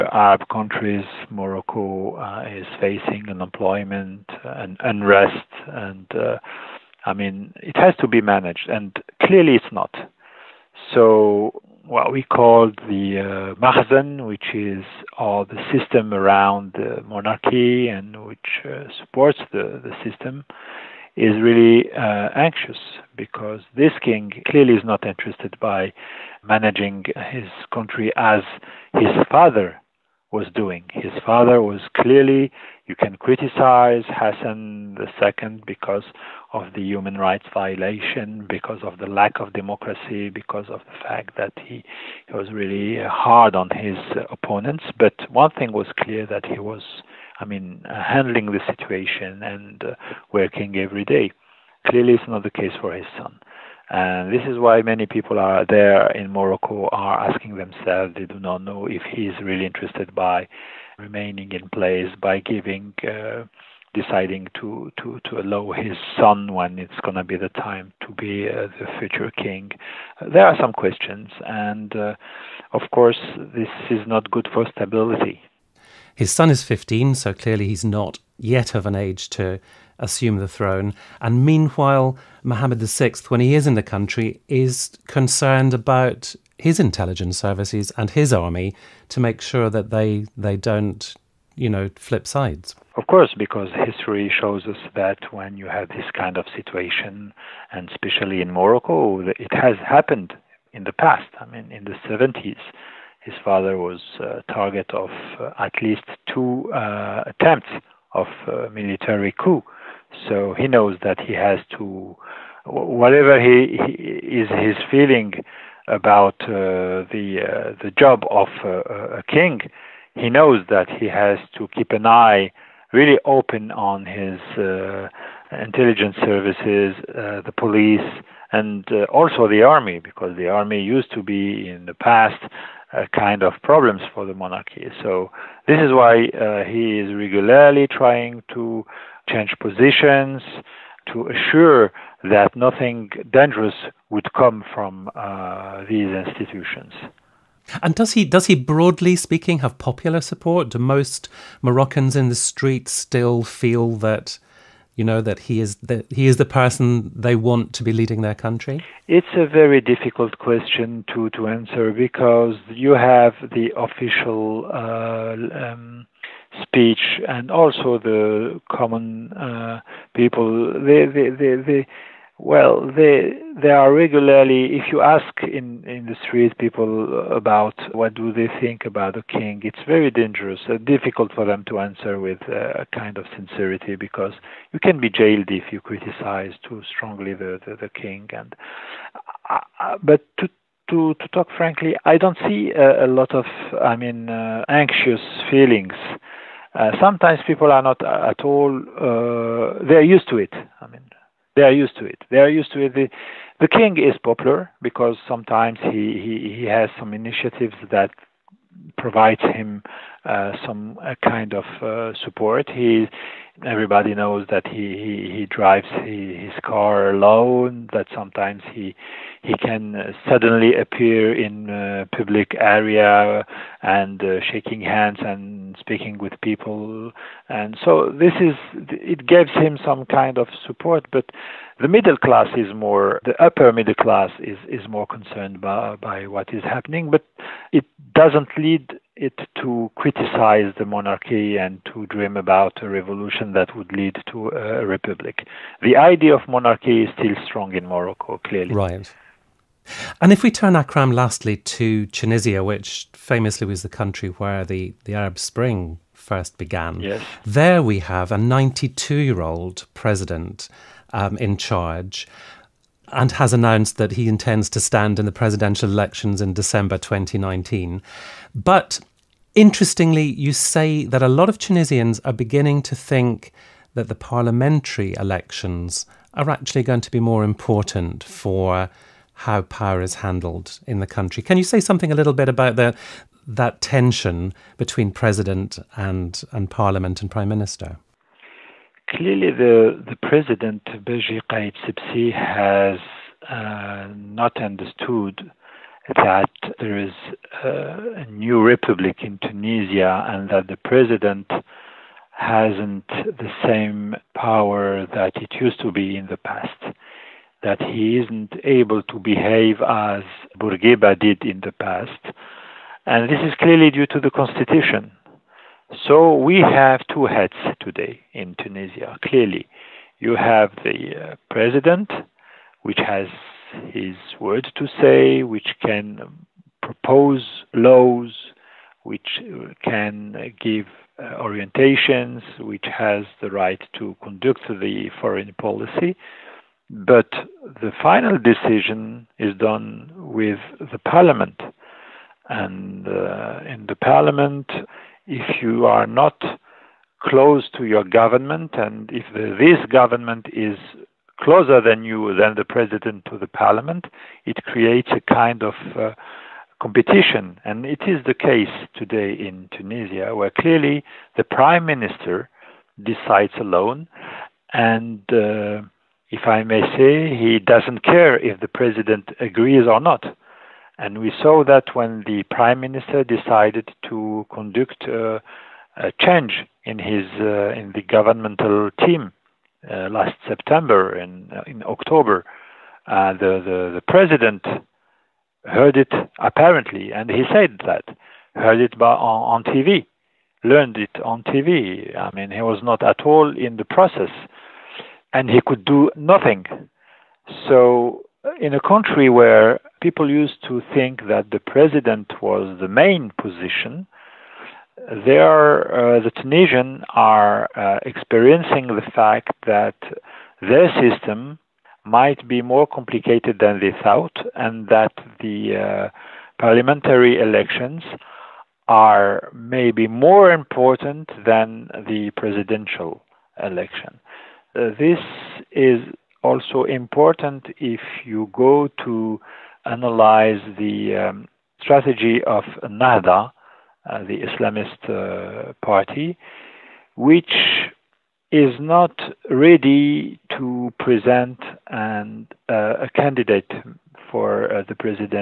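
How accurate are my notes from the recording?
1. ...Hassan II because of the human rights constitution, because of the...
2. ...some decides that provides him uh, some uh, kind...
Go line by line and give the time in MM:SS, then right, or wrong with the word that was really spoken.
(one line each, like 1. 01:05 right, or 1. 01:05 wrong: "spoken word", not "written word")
1. 00:34 wrong: "violation", not "constitution"
2. 03:26 wrong: "initiatives", not "decides".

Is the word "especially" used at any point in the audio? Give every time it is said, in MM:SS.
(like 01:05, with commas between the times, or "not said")
01:37.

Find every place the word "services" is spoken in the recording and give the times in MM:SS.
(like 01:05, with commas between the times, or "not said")
01:27, 02:06.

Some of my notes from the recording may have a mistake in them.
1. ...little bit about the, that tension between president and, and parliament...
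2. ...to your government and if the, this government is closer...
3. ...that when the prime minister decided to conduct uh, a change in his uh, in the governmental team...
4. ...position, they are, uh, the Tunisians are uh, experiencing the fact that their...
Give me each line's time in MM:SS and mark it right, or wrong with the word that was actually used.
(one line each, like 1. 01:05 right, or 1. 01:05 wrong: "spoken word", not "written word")
1. 04:42 right
2. 05:47 right
3. 06:11 right
4. 06:43 right.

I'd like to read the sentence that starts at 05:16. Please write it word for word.
So we have two heads today in Tunisia, clearly.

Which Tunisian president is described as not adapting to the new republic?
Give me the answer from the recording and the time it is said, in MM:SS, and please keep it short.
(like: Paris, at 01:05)
Beji Qaid Sibsi, at 04:50.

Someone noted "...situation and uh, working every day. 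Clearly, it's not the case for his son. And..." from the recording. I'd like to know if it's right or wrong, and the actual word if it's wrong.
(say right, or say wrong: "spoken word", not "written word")
right.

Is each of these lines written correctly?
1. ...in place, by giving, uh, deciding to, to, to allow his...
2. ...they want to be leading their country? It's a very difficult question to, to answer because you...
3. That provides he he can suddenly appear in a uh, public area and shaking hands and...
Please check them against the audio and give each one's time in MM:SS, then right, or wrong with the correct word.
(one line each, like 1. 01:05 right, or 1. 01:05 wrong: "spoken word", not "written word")
1. 01:01 right
2. 02:37 right
3. 03:37 wrong: "sometimes", not "provides".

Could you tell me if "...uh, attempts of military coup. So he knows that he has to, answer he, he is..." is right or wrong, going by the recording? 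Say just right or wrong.
wrong.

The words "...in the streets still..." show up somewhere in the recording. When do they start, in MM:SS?
02:32.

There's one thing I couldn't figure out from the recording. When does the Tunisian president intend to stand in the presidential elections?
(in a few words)
December 2019.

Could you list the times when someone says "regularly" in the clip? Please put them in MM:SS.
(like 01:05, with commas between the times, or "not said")
02:17, 02:53.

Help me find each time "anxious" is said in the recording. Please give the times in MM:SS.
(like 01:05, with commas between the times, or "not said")
00:22, 03:14.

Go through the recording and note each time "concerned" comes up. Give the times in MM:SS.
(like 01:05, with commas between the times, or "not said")
01:25, 03:55.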